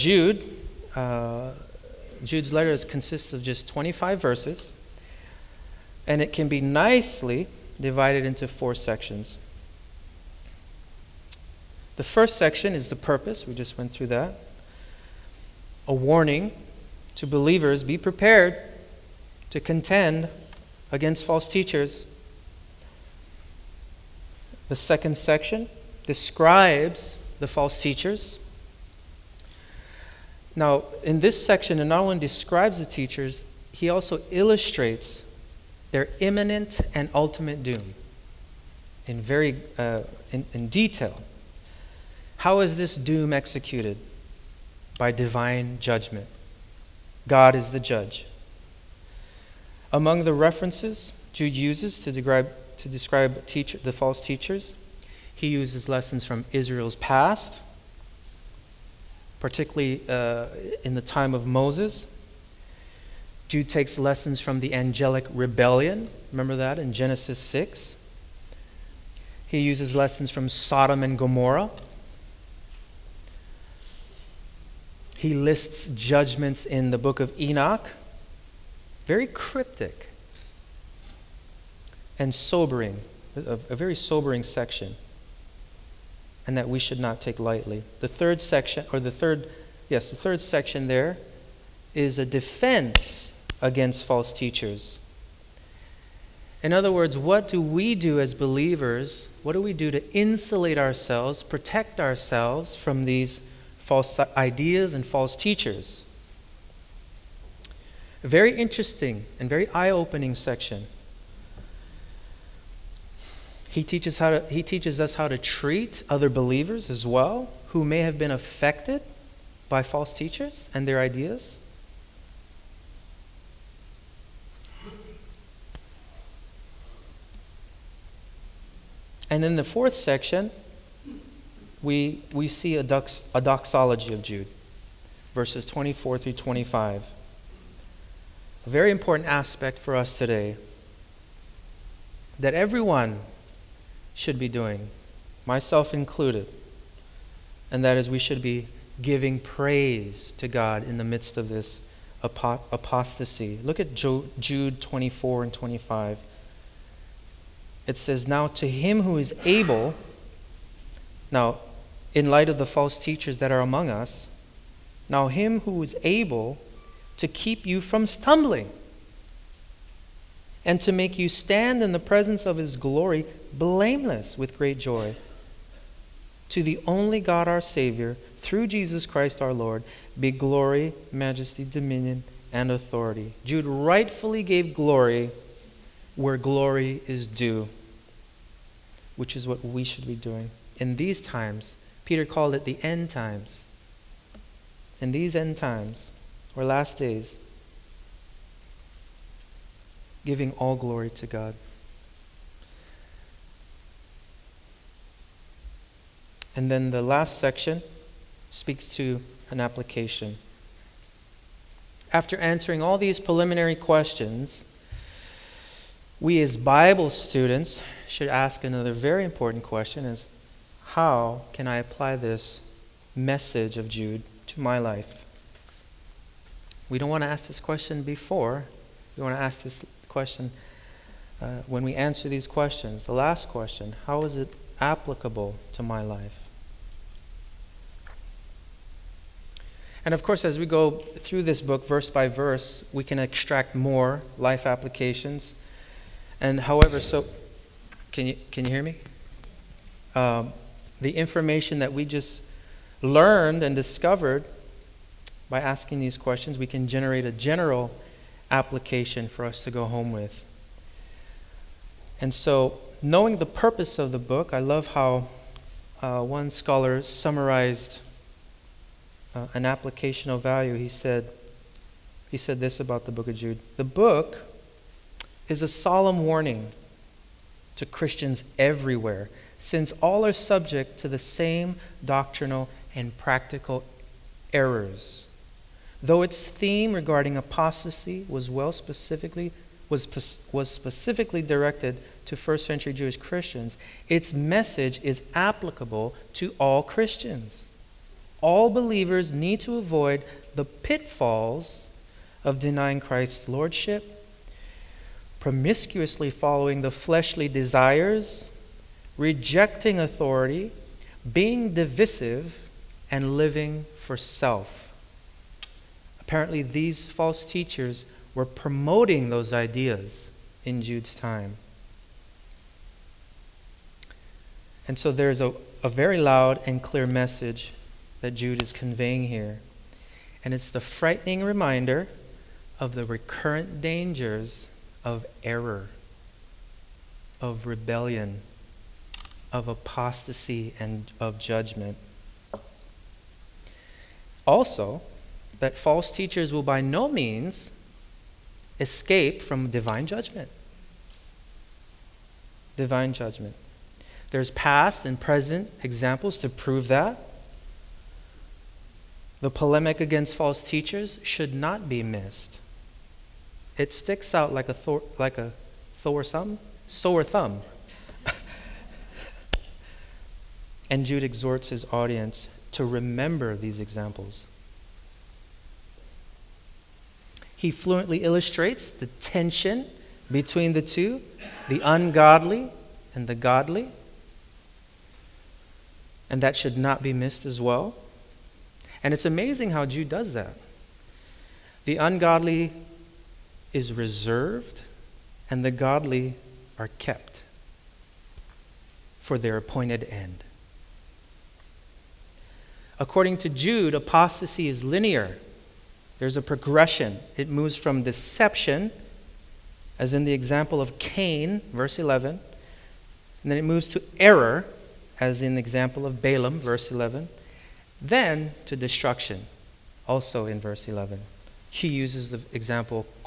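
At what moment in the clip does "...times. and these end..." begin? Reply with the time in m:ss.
3:13.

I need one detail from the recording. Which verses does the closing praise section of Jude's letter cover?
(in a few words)
24 through 25.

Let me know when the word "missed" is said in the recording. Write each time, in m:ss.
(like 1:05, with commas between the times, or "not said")
6:02, 6:27.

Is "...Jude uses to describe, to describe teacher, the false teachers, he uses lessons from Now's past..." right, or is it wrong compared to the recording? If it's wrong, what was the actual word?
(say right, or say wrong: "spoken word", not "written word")
wrong: "Israel", not "Now".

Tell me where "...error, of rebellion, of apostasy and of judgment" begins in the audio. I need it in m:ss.
5:35.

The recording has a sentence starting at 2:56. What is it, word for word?
To the only God our Savior, through Jesus Christ our Lord, be glory, majesty, dominion, and authority.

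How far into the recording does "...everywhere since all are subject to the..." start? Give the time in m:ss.
4:38.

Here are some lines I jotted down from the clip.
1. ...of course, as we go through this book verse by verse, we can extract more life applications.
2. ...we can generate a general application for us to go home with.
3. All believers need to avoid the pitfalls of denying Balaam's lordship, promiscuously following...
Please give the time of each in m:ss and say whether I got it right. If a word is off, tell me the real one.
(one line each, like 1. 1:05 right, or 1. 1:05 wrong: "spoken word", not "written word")
1. 4:00 right
2. 4:16 right
3. 4:58 wrong: "Christ", not "Balaam".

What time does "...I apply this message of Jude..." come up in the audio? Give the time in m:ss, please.
3:41.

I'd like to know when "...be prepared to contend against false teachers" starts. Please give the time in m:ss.
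0:17.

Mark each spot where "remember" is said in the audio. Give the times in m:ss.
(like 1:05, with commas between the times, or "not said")
1:06, 6:12.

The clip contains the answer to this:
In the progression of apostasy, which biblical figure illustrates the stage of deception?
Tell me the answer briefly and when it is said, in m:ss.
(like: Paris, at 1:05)
Cain, at 6:50.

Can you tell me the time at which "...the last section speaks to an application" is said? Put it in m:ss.
3:26.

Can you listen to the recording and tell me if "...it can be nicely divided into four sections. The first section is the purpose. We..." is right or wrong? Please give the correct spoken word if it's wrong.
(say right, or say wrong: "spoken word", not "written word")
right.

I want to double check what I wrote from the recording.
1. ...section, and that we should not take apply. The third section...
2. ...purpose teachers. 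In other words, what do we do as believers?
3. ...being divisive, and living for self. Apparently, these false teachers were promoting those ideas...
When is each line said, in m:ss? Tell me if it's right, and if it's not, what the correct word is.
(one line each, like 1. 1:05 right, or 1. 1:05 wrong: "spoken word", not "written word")
1. 1:24 wrong: "lightly", not "apply"
2. 1:34 wrong: "false", not "purpose"
3. 5:11 right.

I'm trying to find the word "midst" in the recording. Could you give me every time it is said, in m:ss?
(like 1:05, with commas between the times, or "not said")
2:31.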